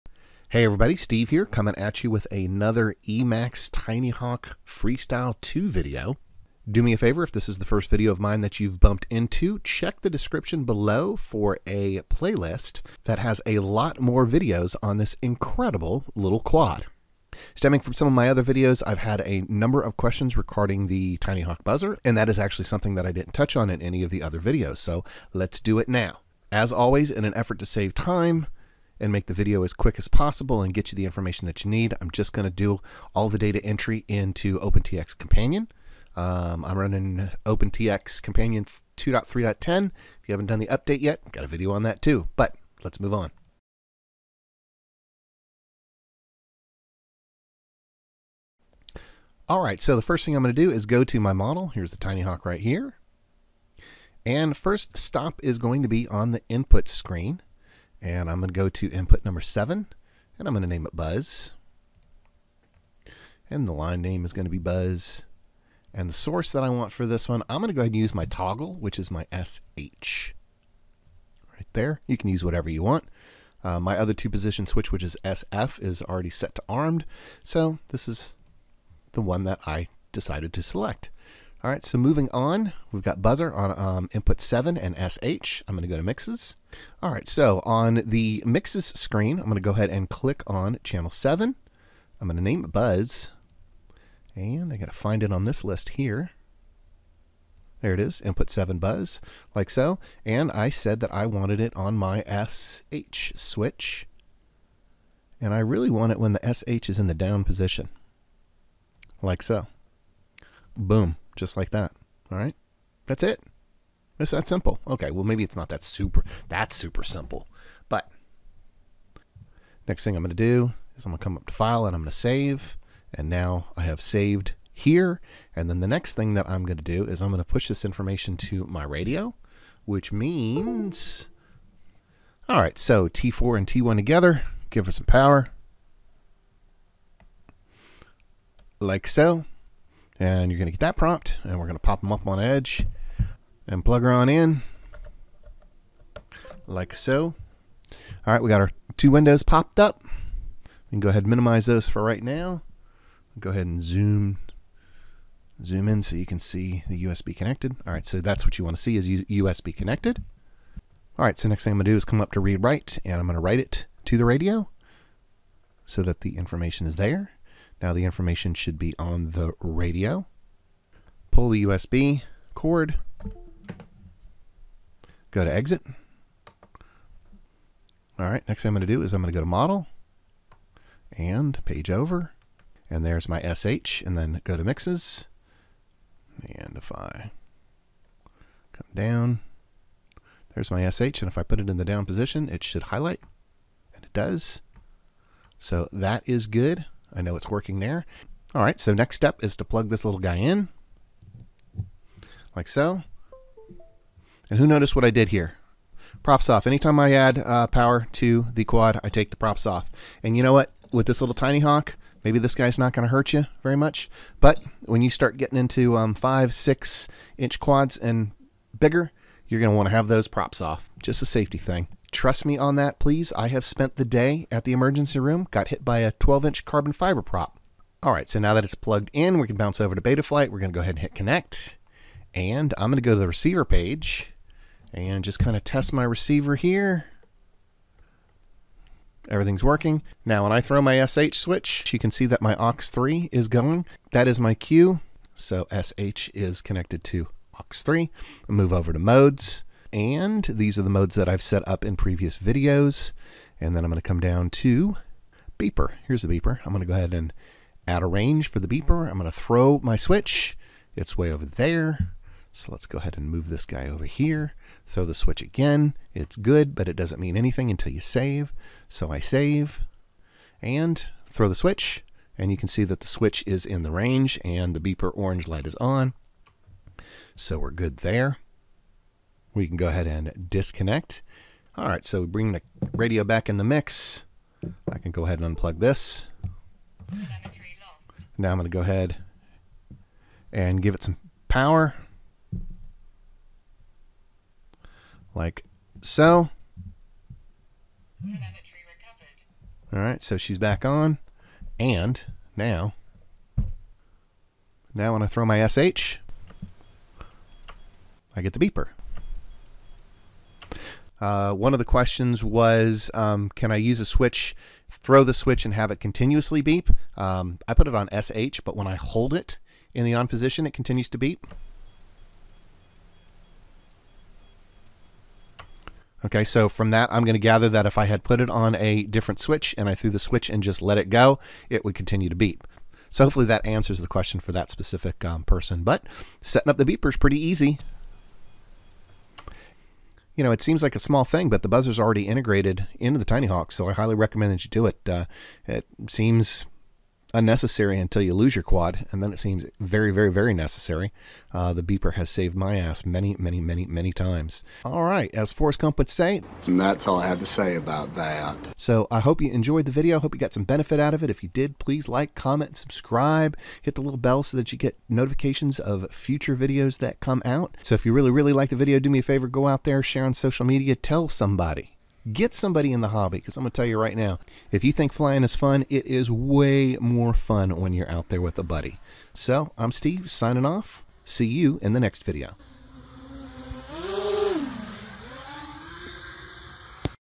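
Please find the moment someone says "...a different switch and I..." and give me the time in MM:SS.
05:28.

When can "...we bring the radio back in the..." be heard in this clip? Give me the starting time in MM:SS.
04:42.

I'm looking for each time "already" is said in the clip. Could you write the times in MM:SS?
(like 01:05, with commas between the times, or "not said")
01:16, 05:41.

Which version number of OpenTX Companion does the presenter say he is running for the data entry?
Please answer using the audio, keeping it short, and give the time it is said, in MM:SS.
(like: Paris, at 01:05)
2.3.10, at 00:38.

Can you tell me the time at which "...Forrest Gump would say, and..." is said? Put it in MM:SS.
05:55.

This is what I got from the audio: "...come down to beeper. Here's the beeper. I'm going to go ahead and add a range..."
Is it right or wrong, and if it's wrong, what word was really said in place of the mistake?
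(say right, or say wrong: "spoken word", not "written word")
right.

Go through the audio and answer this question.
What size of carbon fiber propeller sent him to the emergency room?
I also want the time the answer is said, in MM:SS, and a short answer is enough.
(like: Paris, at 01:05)
12 inch, at 03:46.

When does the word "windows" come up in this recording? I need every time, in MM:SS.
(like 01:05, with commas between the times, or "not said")
02:29.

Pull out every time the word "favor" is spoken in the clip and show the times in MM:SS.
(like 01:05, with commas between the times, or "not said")
00:06, 06:09.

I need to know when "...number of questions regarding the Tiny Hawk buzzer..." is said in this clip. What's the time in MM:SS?
00:19.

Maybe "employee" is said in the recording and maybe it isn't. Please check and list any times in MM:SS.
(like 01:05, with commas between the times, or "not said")
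not said.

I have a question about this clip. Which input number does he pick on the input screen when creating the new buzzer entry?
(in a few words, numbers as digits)
7.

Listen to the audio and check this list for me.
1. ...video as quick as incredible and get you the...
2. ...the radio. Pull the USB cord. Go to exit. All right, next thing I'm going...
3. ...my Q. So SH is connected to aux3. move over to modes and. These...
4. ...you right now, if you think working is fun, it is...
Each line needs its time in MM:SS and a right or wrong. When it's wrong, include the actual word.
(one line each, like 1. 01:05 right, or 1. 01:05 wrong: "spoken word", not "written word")
1. 00:29 wrong: "possible", not "incredible"
2. 02:49 right
3. 04:04 right
4. 06:13 wrong: "flying", not "working".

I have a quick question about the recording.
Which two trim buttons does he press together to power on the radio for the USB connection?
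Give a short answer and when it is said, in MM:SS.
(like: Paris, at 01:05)
T4 and T1, at 02:13.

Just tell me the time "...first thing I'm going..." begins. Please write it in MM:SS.
00:50.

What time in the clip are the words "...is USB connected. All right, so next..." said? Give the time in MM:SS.
02:38.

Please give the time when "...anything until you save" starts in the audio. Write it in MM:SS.
04:27.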